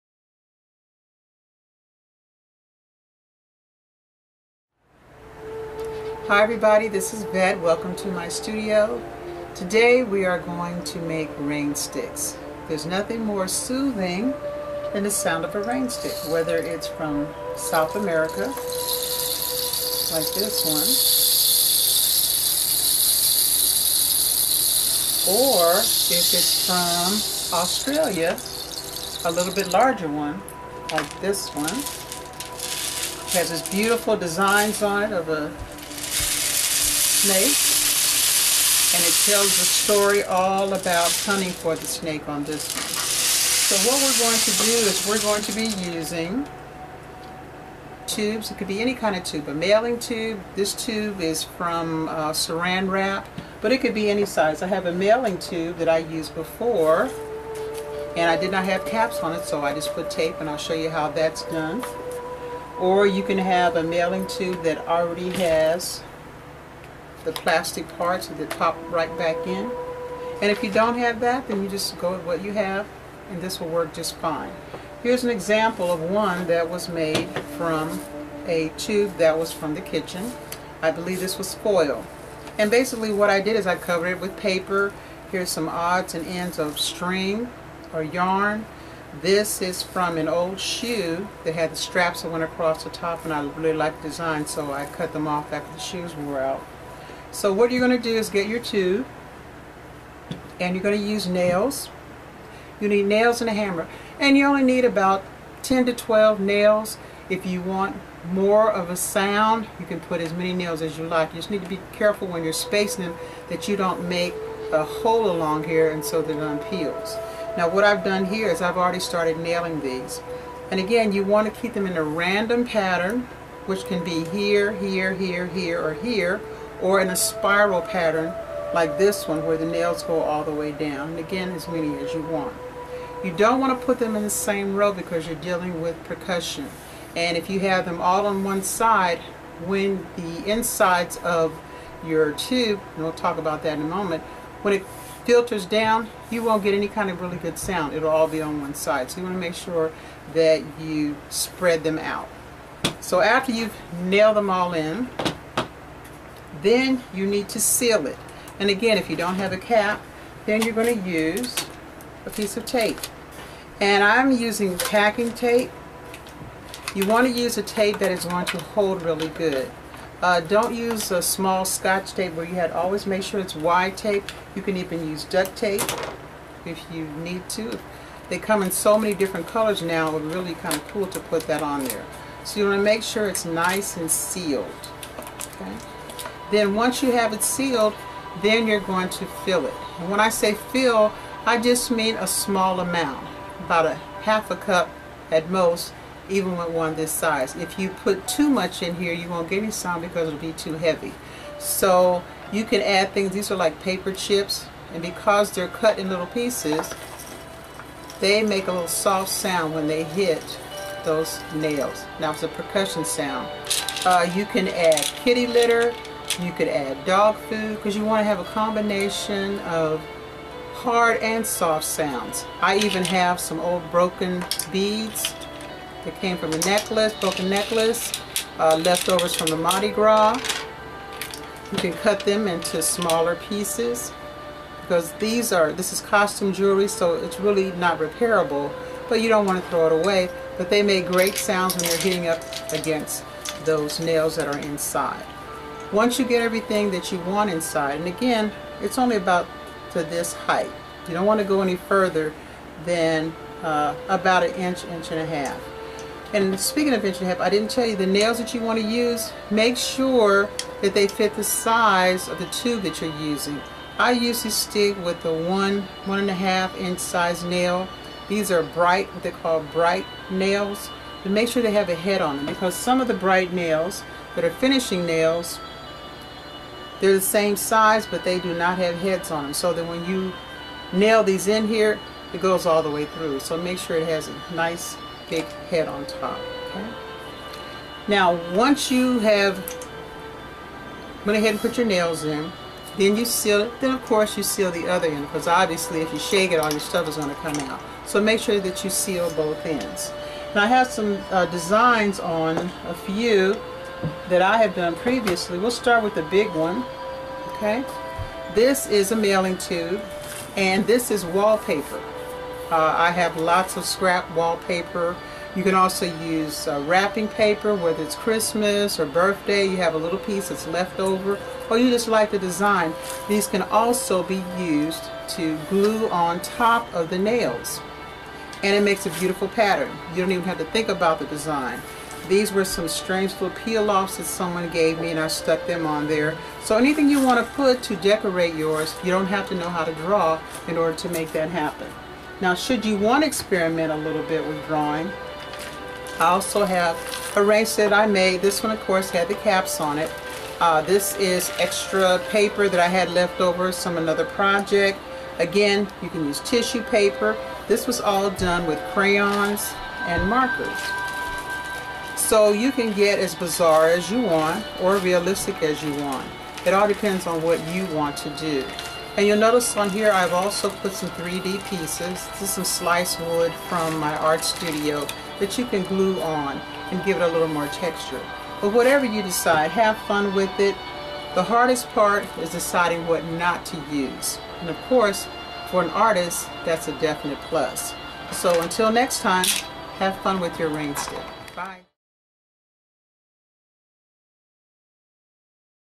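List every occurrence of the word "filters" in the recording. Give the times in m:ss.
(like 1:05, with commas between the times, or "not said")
2:25.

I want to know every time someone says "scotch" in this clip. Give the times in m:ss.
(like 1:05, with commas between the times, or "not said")
2:51.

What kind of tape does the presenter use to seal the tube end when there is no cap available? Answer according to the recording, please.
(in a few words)
Packing tape.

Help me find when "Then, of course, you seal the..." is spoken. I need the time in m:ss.
4:53.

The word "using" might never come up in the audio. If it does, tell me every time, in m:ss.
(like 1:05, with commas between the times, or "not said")
0:45, 2:44, 4:23.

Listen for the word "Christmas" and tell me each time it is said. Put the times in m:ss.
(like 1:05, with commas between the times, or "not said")
5:18.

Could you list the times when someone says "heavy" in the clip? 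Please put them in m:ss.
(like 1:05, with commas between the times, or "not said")
3:20.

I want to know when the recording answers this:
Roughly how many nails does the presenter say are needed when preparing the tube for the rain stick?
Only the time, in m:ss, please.
1:45.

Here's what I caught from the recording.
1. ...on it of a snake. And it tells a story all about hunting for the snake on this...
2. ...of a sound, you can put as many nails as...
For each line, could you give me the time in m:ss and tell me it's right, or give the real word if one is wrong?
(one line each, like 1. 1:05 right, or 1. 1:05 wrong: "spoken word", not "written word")
1. 0:34 right
2. 1:48 right.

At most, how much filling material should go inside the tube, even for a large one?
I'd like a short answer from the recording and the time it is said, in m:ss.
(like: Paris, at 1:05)
Half a cup, at 3:13.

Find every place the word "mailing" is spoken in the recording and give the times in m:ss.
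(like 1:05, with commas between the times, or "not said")
0:49, 0:54, 1:03, 5:09.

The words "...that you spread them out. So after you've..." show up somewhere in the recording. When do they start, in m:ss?
2:30.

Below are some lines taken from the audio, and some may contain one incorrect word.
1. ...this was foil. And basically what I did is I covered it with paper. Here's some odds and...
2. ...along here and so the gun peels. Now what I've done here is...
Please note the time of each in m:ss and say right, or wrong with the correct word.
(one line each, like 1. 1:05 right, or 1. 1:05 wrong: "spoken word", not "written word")
1. 1:21 right
2. 1:55 right.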